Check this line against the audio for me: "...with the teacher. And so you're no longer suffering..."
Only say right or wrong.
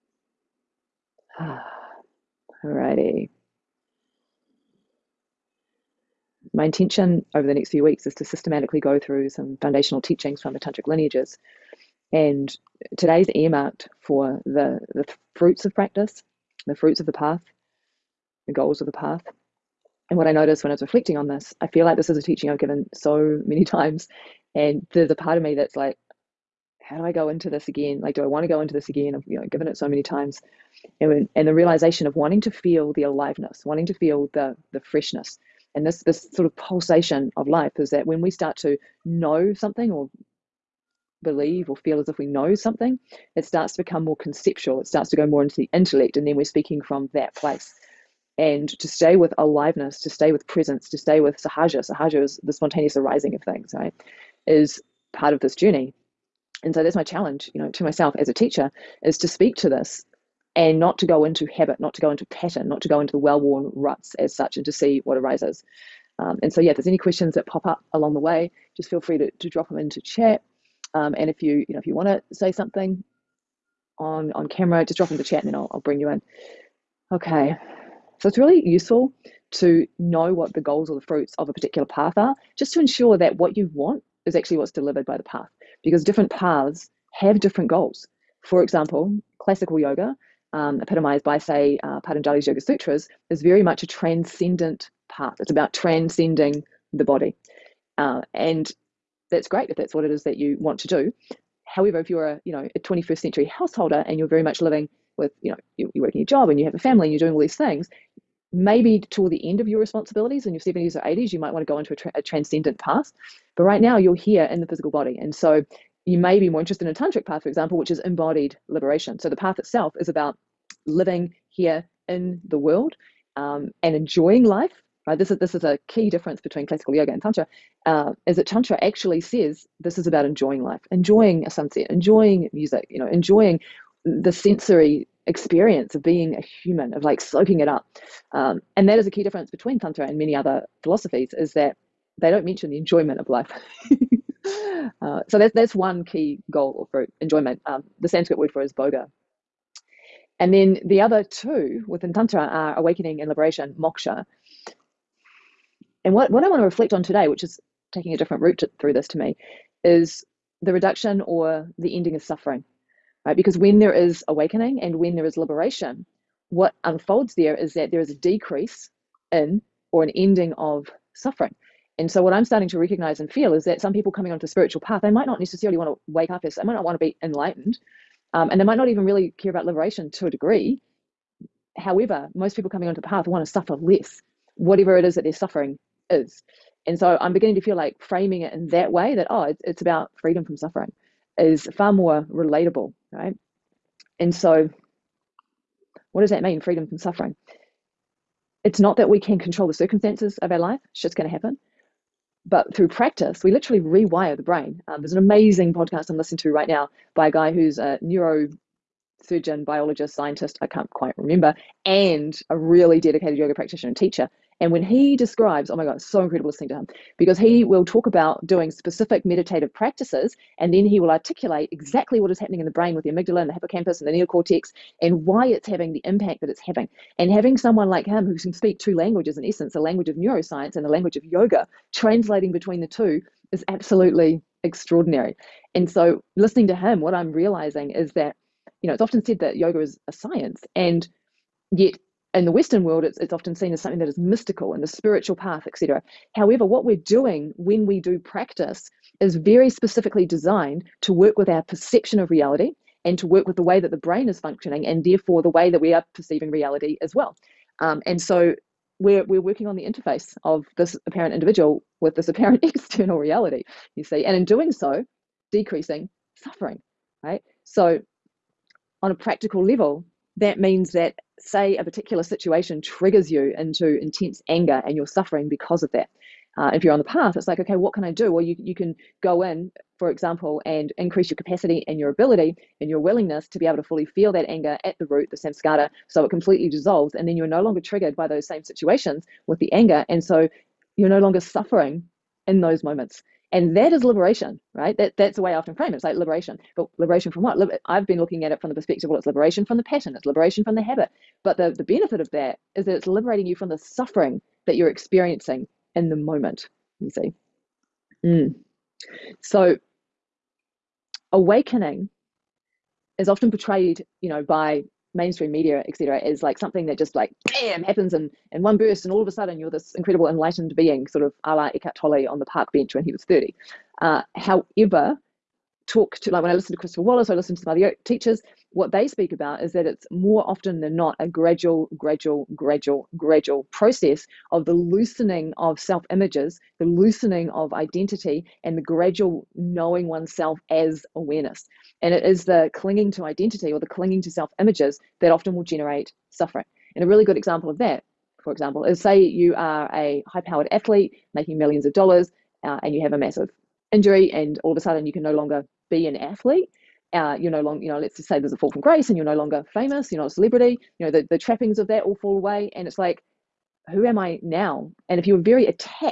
wrong.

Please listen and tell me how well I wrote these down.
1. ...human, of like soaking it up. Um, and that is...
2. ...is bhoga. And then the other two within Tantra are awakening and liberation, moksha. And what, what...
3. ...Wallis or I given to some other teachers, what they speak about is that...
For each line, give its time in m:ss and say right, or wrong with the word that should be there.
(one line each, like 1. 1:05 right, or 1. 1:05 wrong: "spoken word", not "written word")
1. 2:16 right
2. 2:28 right
3. 5:27 wrong: "listen", not "given".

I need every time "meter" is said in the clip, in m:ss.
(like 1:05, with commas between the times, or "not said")
not said.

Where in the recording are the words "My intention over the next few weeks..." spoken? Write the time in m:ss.
0:06.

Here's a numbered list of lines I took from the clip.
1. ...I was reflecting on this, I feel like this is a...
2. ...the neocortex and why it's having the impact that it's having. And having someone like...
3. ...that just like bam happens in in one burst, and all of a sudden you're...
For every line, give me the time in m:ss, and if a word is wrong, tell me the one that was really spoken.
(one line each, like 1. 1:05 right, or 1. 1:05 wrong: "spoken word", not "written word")
1. 0:20 right
2. 3:44 right
3. 5:16 right.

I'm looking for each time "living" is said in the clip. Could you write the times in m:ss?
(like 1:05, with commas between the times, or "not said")
1:44, 2:00.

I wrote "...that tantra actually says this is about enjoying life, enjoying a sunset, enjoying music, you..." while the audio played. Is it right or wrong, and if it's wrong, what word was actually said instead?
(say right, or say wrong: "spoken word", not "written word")
right.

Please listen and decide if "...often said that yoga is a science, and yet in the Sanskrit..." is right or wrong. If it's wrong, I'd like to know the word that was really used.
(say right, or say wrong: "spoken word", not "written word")
wrong: "Western", not "Sanskrit".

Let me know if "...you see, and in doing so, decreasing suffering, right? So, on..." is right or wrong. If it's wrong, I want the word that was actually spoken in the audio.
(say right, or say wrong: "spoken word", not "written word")
right.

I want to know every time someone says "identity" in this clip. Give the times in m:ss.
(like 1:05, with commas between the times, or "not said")
5:37, 5:43.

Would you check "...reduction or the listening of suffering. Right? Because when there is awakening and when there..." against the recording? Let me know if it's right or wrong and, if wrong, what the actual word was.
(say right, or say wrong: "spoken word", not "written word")
wrong: "ending", not "listening".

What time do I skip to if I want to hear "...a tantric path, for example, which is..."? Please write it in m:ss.
1:56.